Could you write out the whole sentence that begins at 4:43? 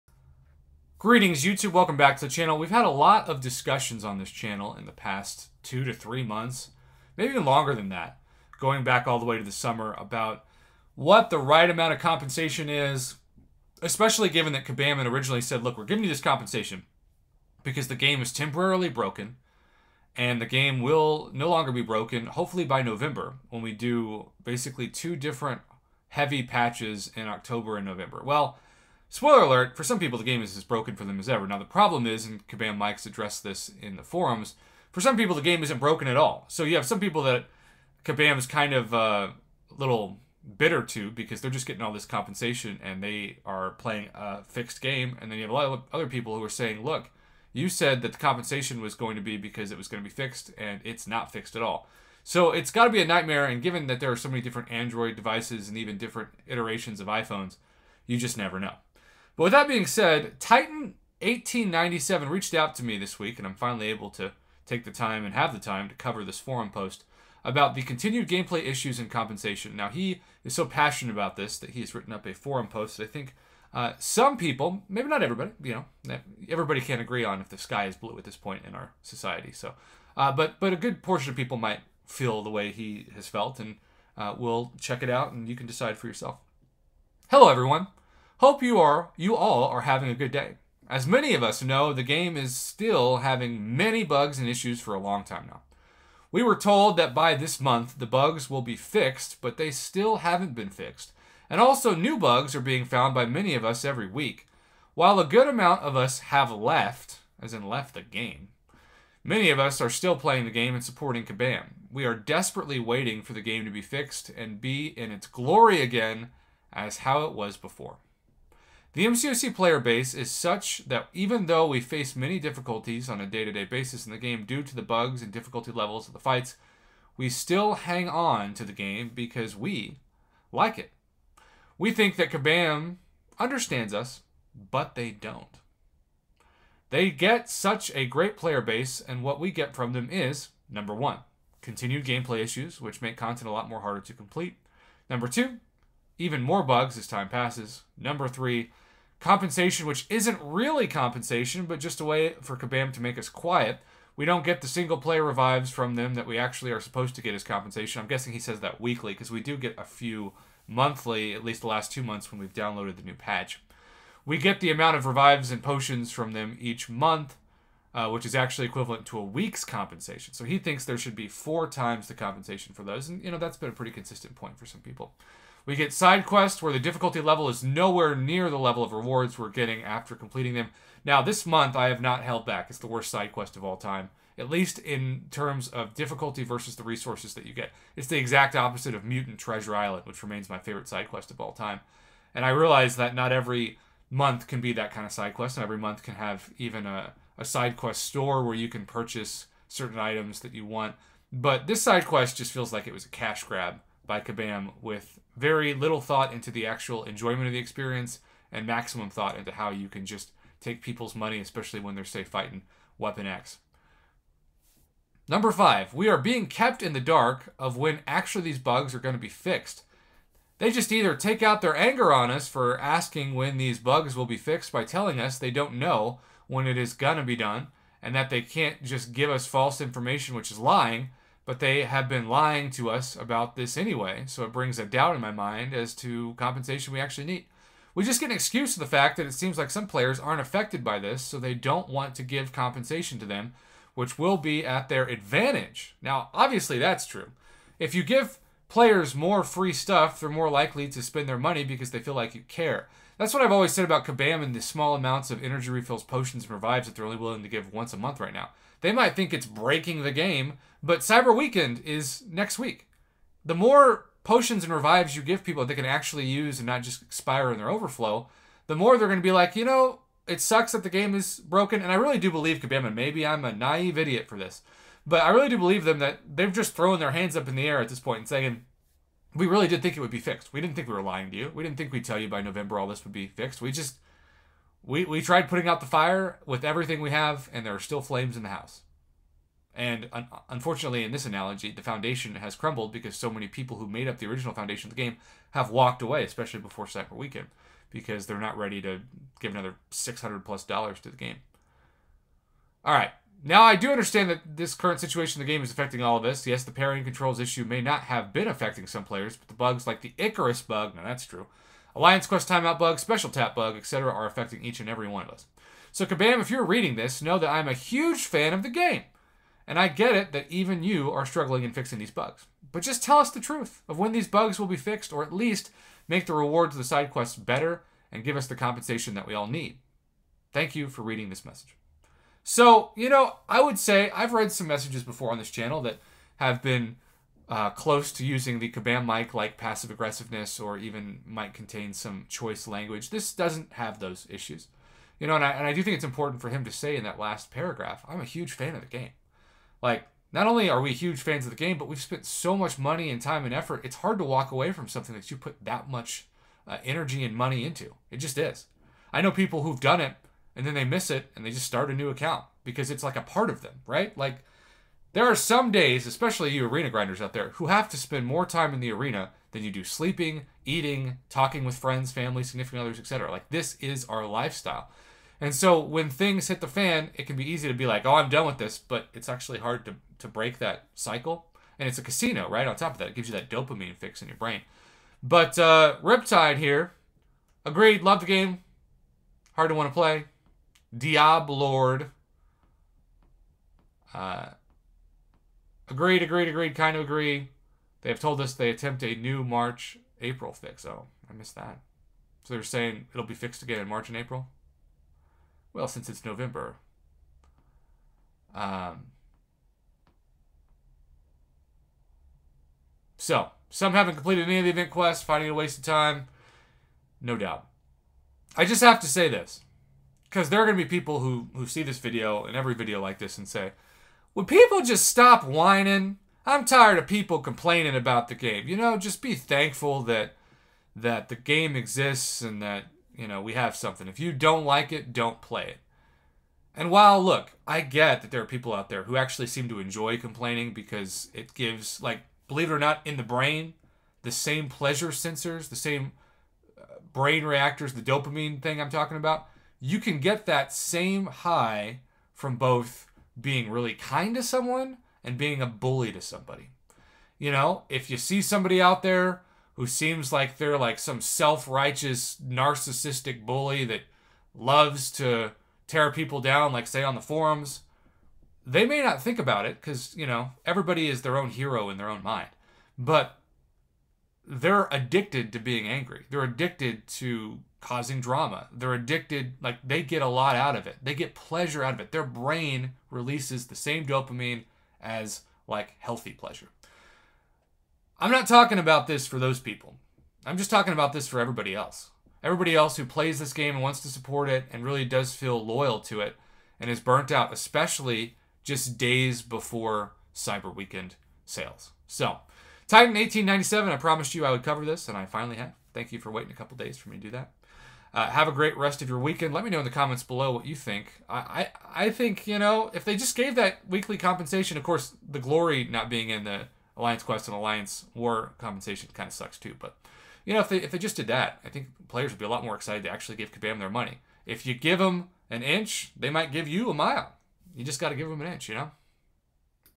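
We just we we tried putting out the fire with everything we have, and there are still flames in the house.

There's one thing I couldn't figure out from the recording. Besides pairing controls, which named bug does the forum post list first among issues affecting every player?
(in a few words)
Icarus bug.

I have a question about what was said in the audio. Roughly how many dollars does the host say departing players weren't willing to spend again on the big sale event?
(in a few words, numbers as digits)
600.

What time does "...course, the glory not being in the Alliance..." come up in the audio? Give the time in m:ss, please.
8:34.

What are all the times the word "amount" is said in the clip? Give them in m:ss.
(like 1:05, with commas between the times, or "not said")
0:11, 1:45, 2:44, 4:14.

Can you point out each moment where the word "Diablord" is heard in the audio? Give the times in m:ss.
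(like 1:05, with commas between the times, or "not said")
6:30.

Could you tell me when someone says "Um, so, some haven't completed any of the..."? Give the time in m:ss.
6:48.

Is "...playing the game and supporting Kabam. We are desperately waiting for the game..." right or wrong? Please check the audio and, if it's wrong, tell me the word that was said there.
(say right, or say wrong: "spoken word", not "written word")
right.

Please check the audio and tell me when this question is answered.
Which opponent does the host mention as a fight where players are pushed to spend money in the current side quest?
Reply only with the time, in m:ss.
3:32.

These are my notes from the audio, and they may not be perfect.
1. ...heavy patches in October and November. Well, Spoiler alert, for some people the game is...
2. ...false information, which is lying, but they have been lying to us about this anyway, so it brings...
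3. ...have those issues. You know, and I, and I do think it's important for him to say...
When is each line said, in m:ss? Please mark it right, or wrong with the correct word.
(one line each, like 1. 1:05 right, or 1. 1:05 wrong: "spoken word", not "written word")
1. 0:26 right
2. 3:49 right
3. 5:43 right.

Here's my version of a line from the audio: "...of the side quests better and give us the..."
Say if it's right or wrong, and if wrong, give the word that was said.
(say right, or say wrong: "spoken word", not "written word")
right.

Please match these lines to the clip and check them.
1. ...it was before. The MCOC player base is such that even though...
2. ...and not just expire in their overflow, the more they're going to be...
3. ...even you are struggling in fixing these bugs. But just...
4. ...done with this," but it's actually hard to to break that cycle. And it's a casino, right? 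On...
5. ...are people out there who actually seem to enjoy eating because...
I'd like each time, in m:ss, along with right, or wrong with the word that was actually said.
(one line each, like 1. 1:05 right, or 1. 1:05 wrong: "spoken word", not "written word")
1. 1:57 right
2. 4:26 right
3. 5:20 right
4. 6:18 right
5. 7:18 wrong: "complaining", not "eating".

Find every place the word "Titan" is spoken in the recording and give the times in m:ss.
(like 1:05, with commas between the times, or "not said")
1:00, 8:22.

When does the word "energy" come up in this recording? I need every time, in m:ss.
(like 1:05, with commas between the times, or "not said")
4:15, 5:56.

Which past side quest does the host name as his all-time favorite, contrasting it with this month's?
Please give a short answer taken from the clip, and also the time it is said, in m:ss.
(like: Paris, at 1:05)
Mutant Treasure Island, at 3:09.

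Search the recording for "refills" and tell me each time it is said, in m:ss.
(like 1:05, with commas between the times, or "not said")
4:15.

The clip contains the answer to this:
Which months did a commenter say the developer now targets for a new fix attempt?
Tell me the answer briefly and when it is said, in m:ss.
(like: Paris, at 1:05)
March and April, at 6:39.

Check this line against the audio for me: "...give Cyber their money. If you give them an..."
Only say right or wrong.
wrong.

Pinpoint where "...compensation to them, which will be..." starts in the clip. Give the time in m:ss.
4:02.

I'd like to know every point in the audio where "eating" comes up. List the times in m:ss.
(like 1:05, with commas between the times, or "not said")
6:10.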